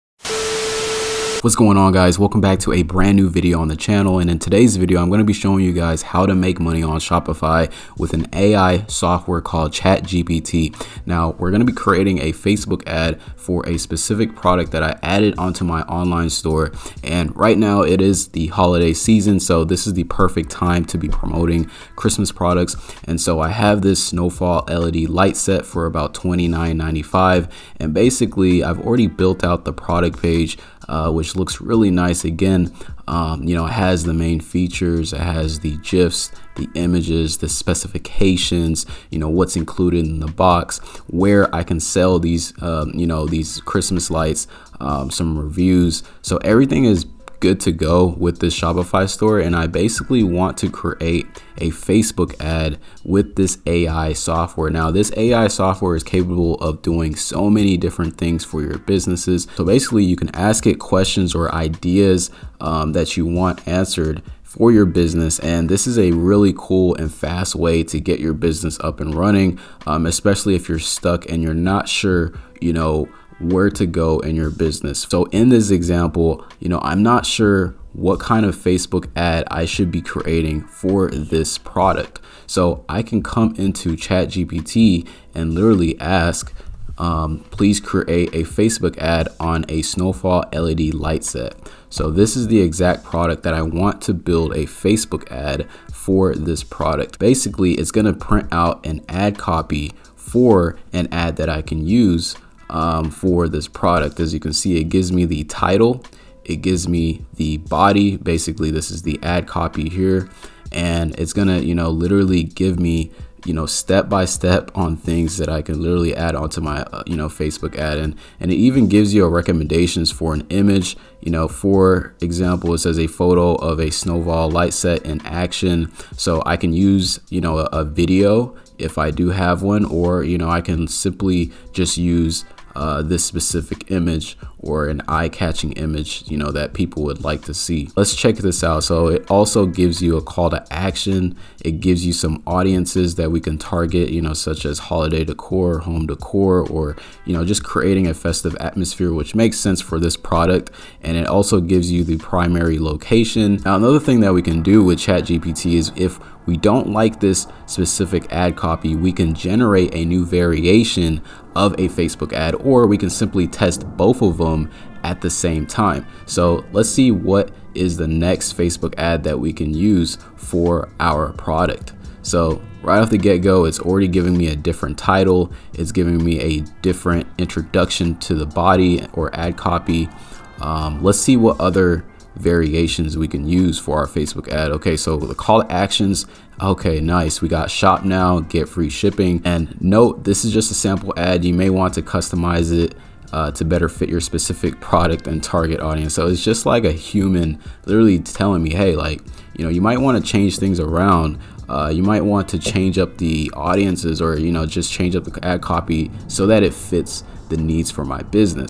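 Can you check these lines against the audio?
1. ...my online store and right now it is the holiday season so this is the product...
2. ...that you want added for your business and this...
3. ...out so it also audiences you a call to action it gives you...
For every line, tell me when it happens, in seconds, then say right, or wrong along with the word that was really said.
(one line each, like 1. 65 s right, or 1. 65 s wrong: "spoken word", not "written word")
1. 15 s wrong: "perfect", not "product"
2. 62 s wrong: "answered", not "added"
3. 138 s wrong: "gives", not "audiences".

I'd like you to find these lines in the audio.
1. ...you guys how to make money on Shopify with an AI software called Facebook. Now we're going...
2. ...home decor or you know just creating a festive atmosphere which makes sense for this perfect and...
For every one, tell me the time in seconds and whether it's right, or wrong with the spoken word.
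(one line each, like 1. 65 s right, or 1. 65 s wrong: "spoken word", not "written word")
1. 5 s wrong: "ChatGPT", not "Facebook"
2. 145 s wrong: "product", not "perfect".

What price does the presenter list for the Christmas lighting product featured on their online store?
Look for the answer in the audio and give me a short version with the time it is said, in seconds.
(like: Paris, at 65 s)
$29.95, at 26 s.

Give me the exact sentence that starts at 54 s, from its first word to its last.
Now, this AI software is capable of doing so many different things for your businesses.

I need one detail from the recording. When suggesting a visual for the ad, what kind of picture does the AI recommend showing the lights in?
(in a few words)
In action.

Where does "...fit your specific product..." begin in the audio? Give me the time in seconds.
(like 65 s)
193 s.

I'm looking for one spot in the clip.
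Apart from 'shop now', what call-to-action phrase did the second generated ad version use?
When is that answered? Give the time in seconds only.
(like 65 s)
188 s.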